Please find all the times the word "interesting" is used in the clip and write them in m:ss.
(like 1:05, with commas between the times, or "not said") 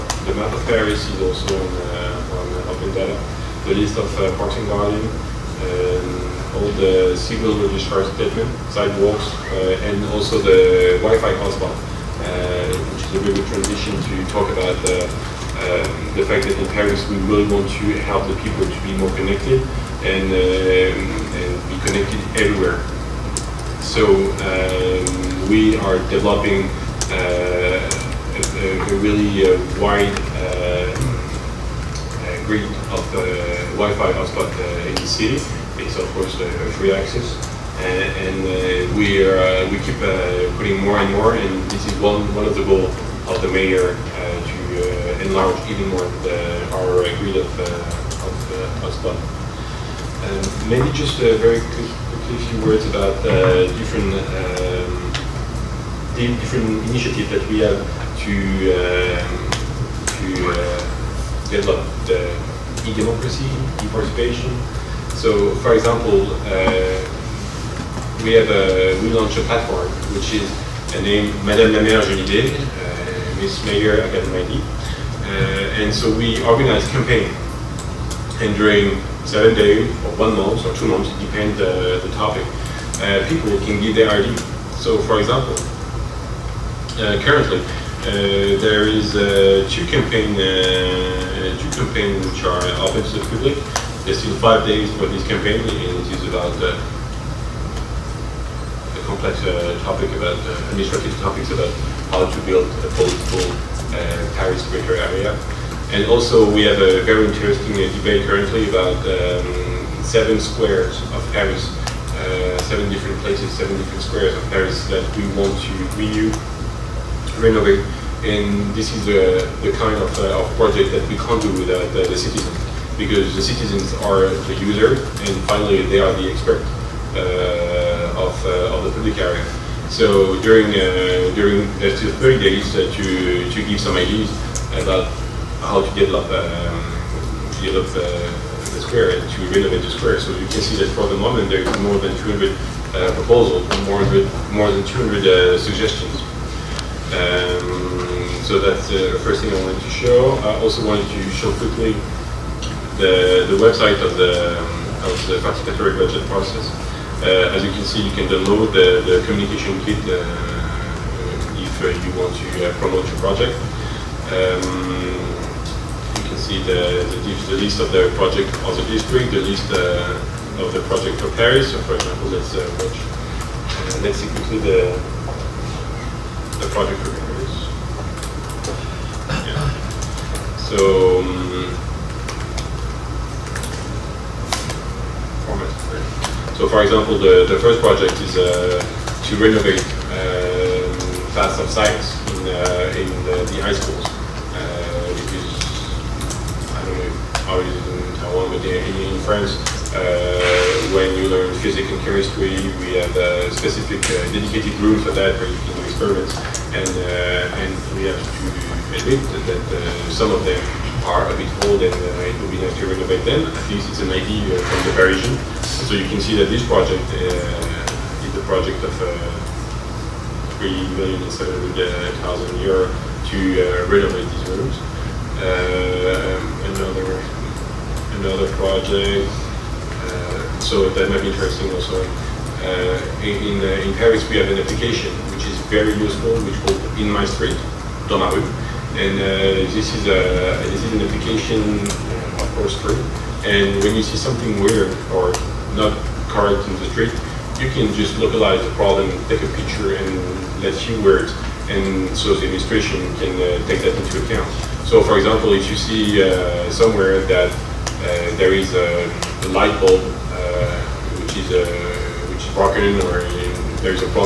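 1:47, 3:51.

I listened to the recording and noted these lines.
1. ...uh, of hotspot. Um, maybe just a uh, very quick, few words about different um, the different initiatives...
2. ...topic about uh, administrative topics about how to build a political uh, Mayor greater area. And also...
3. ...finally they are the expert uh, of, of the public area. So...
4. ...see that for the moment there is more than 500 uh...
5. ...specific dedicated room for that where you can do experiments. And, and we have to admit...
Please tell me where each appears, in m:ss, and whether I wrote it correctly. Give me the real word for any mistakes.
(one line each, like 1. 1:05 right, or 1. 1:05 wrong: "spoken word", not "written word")
1. 0:47 right
2. 1:39 wrong: "Paris", not "Mayor"
3. 2:05 right
4. 2:20 wrong: "200", not "500"
5. 3:23 right.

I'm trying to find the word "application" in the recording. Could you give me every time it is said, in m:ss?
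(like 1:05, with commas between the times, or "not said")
3:54, 4:01.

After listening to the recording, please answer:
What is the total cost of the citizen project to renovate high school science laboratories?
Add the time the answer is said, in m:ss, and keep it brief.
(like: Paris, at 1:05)
3.7 million euros, at 3:40.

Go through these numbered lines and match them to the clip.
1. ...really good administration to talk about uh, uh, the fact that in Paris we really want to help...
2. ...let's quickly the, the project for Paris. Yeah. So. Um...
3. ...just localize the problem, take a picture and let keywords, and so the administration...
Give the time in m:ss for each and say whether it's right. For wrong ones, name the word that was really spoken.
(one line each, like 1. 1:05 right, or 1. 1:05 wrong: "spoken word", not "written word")
1. 0:13 wrong: "transition", not "administration"
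2. 2:54 right
3. 4:07 right.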